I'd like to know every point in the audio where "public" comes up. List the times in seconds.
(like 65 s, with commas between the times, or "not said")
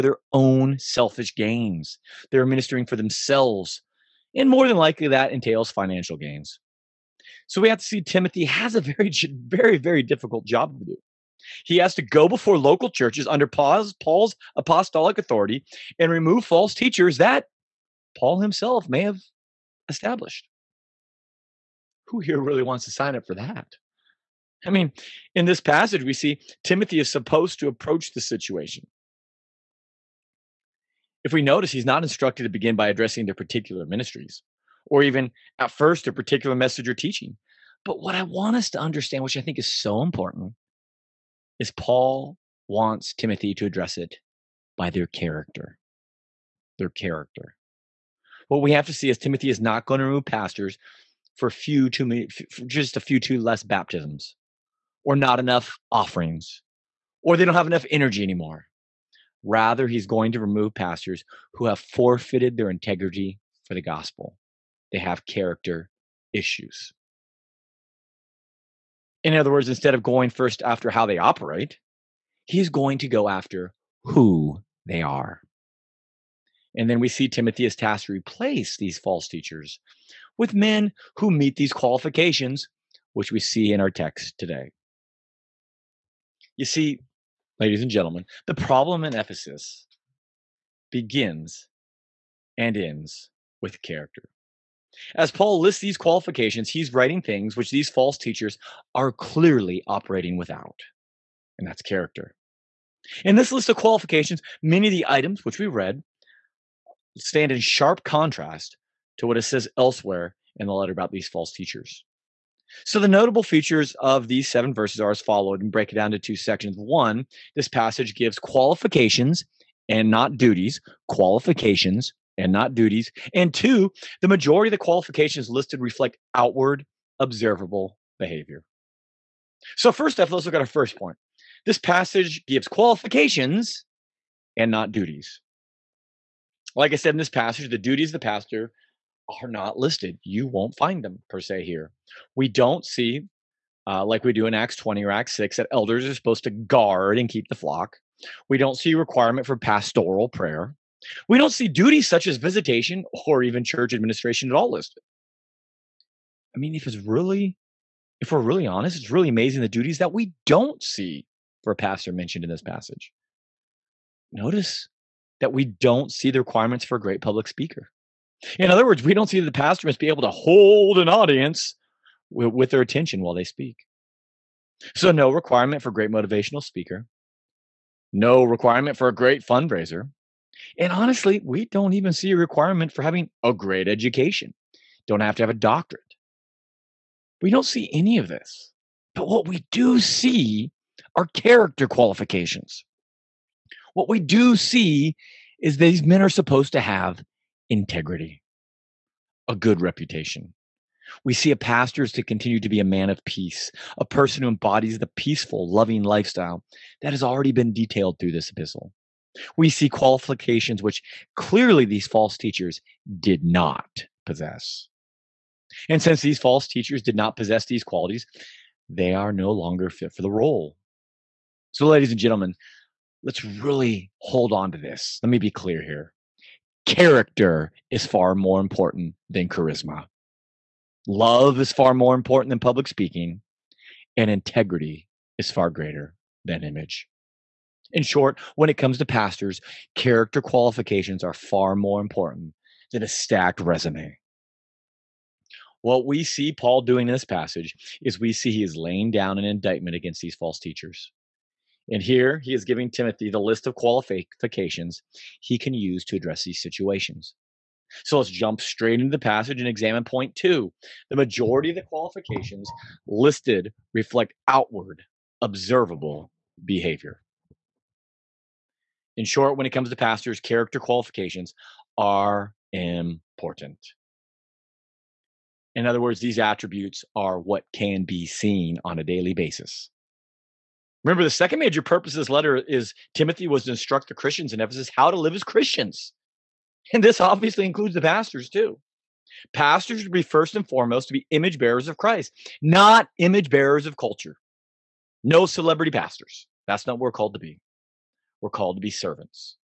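167 s, 232 s.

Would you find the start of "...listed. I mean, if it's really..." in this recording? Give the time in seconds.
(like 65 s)
154 s.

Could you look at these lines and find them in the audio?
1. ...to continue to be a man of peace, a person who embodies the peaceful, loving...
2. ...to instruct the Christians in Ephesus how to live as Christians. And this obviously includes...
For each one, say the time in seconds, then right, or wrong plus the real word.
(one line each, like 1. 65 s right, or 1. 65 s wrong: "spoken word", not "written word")
1. 202 s right
2. 283 s right.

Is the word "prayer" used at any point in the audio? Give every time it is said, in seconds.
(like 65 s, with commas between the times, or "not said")
150 s.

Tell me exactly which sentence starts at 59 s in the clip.
Rather, he's going to remove pastors who have forfeited their integrity for the gospel.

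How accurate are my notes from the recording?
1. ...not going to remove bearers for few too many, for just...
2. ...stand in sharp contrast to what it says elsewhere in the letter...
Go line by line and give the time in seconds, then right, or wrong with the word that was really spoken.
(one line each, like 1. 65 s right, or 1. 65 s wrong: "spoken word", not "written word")
1. 49 s wrong: "pastors", not "bearers"
2. 107 s right.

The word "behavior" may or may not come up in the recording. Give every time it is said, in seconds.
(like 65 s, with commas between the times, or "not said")
128 s, 266 s.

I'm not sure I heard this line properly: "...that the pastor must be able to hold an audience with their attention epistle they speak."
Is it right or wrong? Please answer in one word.
wrong.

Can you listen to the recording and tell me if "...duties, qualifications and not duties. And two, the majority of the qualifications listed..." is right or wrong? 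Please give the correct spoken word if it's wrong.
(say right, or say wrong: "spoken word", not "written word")
right.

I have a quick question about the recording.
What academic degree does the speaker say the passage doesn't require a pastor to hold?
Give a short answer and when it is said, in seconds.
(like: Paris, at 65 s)
A doctorate, at 185 s.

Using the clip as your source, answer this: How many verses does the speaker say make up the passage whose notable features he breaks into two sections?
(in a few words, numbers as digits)
7.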